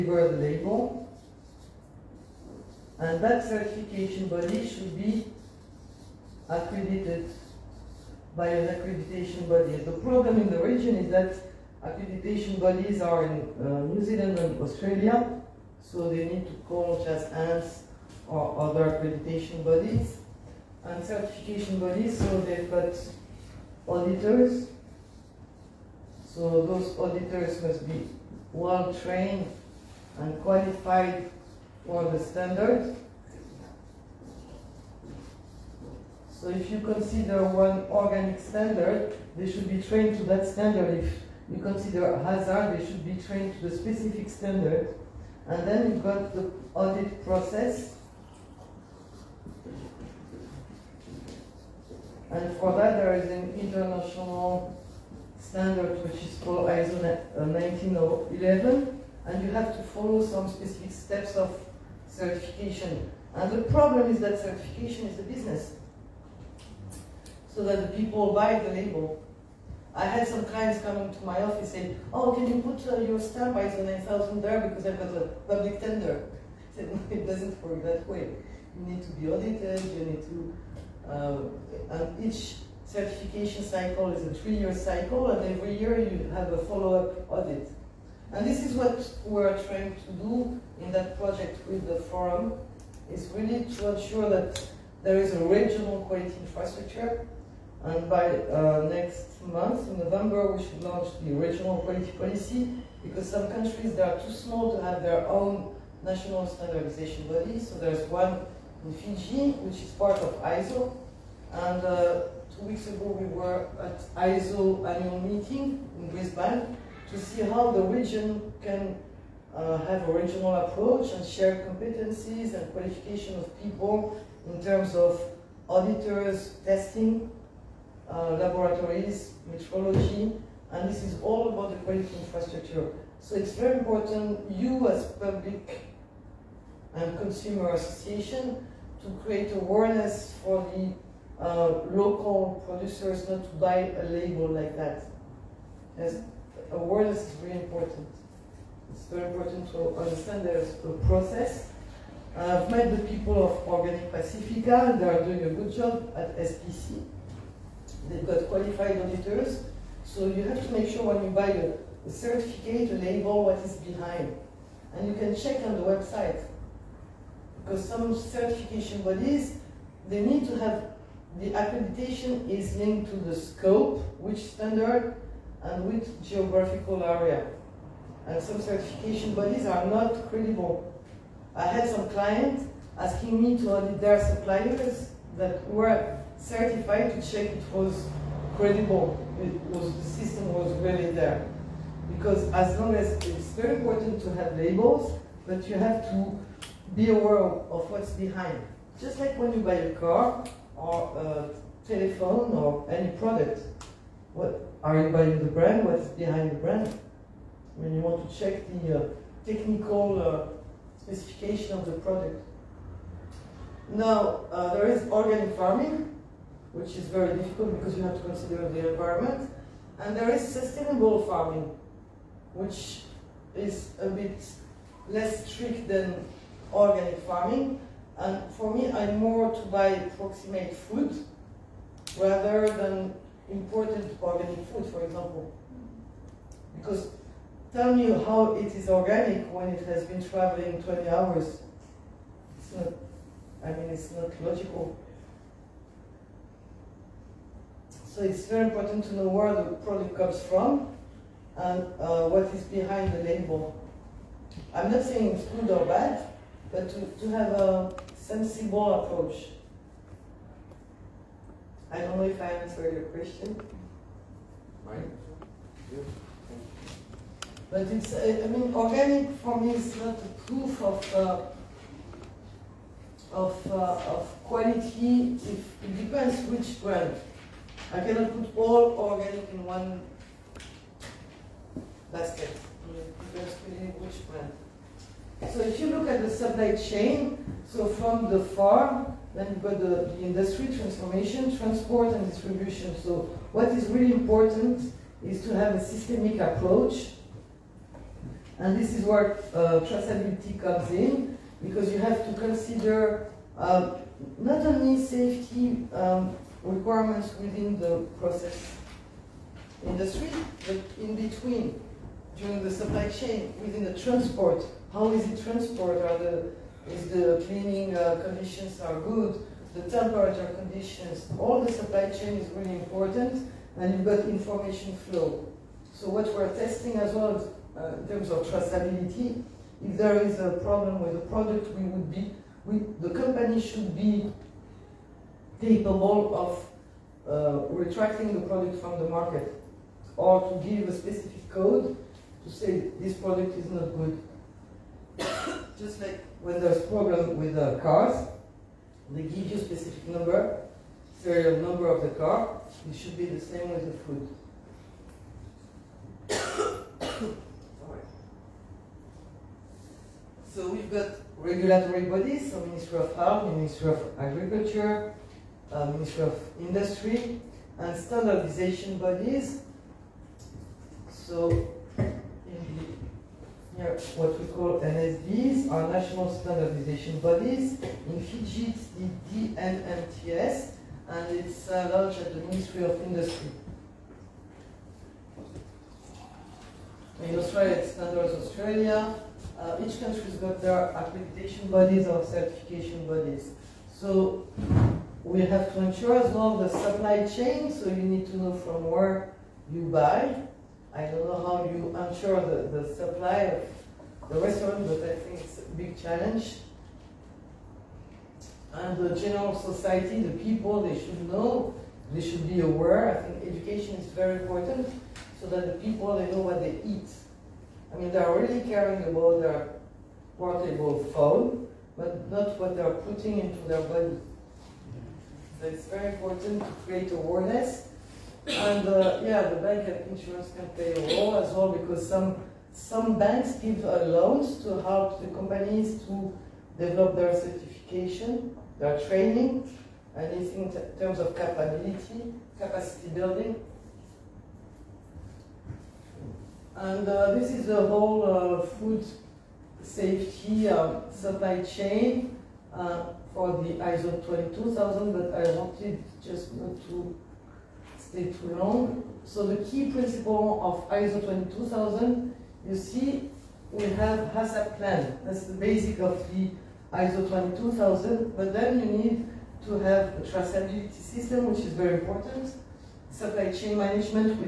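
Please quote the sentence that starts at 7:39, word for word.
So the key principle of ISO 22000, you see, we have HACCP plan.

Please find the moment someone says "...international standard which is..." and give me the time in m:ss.
0:53.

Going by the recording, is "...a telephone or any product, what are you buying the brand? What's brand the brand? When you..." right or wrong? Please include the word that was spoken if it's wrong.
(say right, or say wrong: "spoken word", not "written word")
wrong: "behind", not "brand".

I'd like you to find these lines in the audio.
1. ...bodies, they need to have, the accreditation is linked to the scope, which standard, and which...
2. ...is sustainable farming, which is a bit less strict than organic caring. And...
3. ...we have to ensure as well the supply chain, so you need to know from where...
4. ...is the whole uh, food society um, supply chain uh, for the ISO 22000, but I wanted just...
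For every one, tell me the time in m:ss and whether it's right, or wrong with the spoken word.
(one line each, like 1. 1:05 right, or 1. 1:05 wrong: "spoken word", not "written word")
1. 2:49 right
2. 3:40 wrong: "farming", not "caring"
3. 6:35 right
4. 7:27 wrong: "safety", not "society".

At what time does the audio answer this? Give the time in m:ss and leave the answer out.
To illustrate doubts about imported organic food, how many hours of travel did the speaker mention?
4:00.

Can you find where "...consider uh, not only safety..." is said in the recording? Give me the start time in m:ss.
5:02.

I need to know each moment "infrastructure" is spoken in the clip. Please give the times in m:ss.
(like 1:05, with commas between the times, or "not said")
1:36, 2:12.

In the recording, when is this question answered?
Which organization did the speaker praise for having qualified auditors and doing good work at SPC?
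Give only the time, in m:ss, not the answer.
2:33.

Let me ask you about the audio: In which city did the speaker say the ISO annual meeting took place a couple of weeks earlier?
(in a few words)
Brisbane.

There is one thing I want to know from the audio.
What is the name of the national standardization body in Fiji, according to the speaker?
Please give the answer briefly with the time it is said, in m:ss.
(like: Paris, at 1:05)
NMTS, at 6:19.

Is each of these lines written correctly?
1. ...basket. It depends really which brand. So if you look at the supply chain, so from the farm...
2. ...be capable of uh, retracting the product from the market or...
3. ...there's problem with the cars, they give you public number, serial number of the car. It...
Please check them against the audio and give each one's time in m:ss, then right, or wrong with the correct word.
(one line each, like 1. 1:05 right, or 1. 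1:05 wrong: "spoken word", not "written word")
1. 4:42 right
2. 5:33 right
3. 5:46 wrong: "specific", not "public".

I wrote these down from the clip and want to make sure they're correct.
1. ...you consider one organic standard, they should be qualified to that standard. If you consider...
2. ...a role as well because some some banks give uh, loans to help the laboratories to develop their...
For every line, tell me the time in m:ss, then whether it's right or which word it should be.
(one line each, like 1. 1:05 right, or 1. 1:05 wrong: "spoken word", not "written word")
1. 0:36 wrong: "trained", not "qualified"
2. 7:10 wrong: "companies", not "laboratories".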